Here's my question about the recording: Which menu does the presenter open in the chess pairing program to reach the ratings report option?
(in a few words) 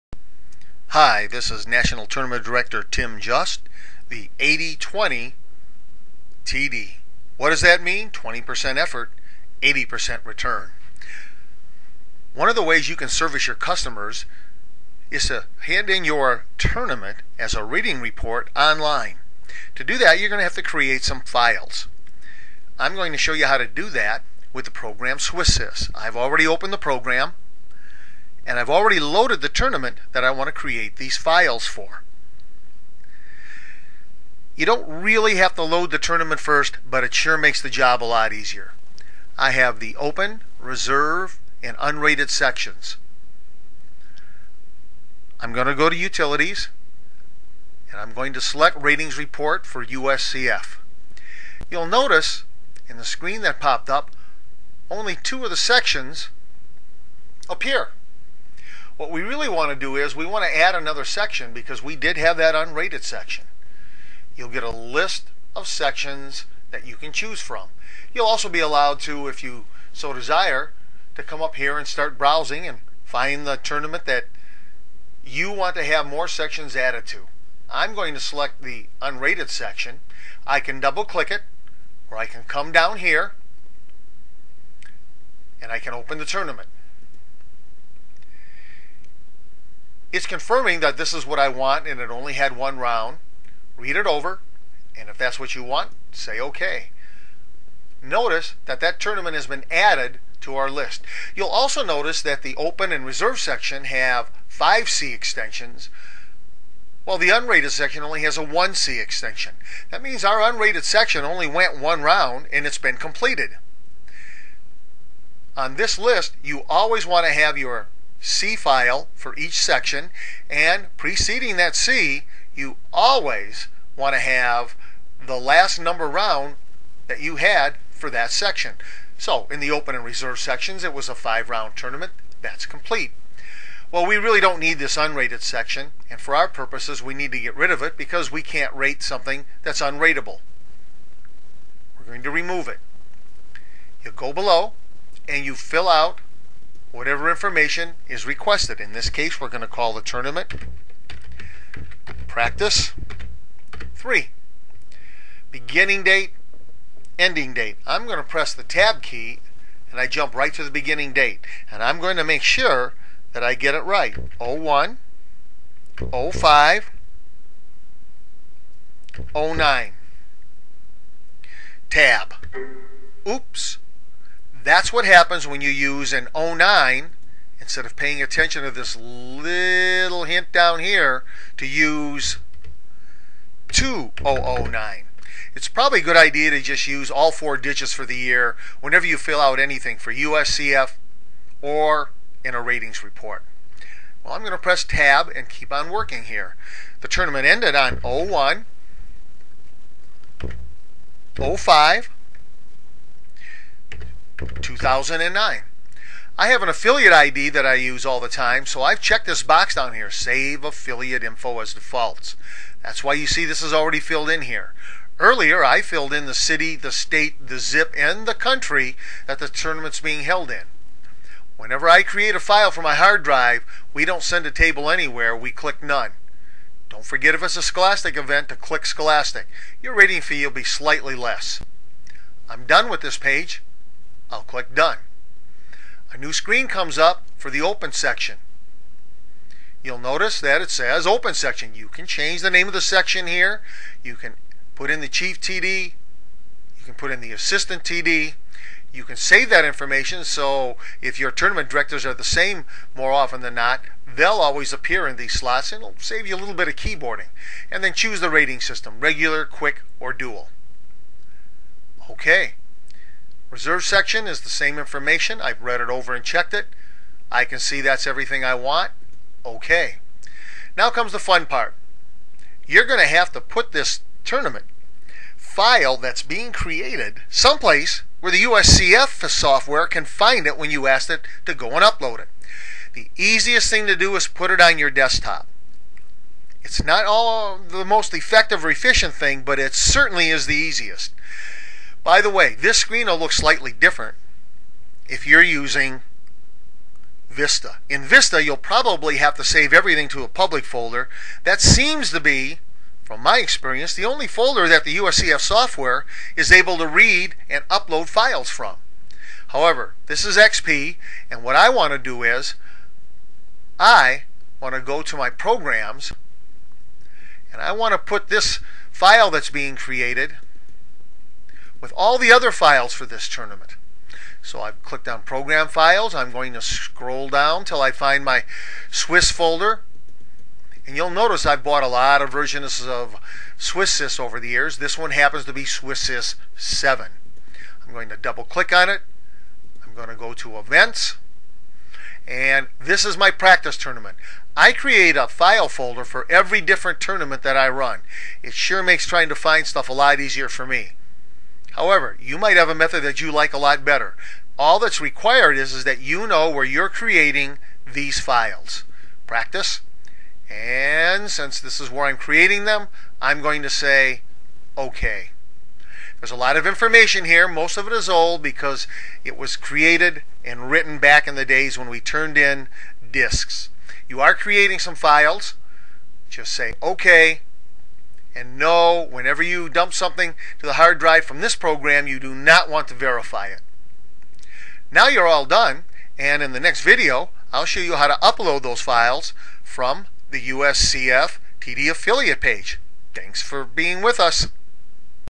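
Utilities.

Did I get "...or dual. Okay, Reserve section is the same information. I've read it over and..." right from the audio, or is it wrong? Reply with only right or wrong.
right.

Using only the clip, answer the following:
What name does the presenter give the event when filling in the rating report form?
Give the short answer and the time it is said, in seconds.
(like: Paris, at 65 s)
practice 3, at 152 s.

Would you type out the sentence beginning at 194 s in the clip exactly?
Well, I'm going to press tab and keep on working here.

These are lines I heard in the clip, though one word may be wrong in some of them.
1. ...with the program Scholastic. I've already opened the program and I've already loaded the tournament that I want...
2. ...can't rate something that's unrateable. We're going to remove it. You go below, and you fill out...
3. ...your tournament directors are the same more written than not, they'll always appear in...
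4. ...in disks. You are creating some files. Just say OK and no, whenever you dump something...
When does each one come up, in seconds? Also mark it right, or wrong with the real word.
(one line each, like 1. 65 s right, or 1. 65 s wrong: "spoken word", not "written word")
1. 24 s wrong: "SwissSys", not "Scholastic"
2. 138 s right
3. 251 s wrong: "often", not "written"
4. 372 s right.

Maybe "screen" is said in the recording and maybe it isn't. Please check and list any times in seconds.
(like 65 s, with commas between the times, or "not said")
53 s, 236 s, 292 s.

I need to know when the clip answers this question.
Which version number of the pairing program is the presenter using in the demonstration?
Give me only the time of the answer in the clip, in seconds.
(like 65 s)
335 s.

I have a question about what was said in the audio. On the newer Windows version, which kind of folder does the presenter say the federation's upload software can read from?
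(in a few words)
public folder.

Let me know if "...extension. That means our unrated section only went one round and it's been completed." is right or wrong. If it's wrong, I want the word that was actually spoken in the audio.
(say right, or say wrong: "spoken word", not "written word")
right.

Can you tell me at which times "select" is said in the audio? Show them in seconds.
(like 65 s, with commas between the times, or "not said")
48 s, 78 s.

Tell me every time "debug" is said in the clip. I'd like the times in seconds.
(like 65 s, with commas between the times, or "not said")
not said.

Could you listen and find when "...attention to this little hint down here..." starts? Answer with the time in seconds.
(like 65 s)
178 s.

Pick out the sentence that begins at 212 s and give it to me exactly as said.
That's why you see this is already filled in here.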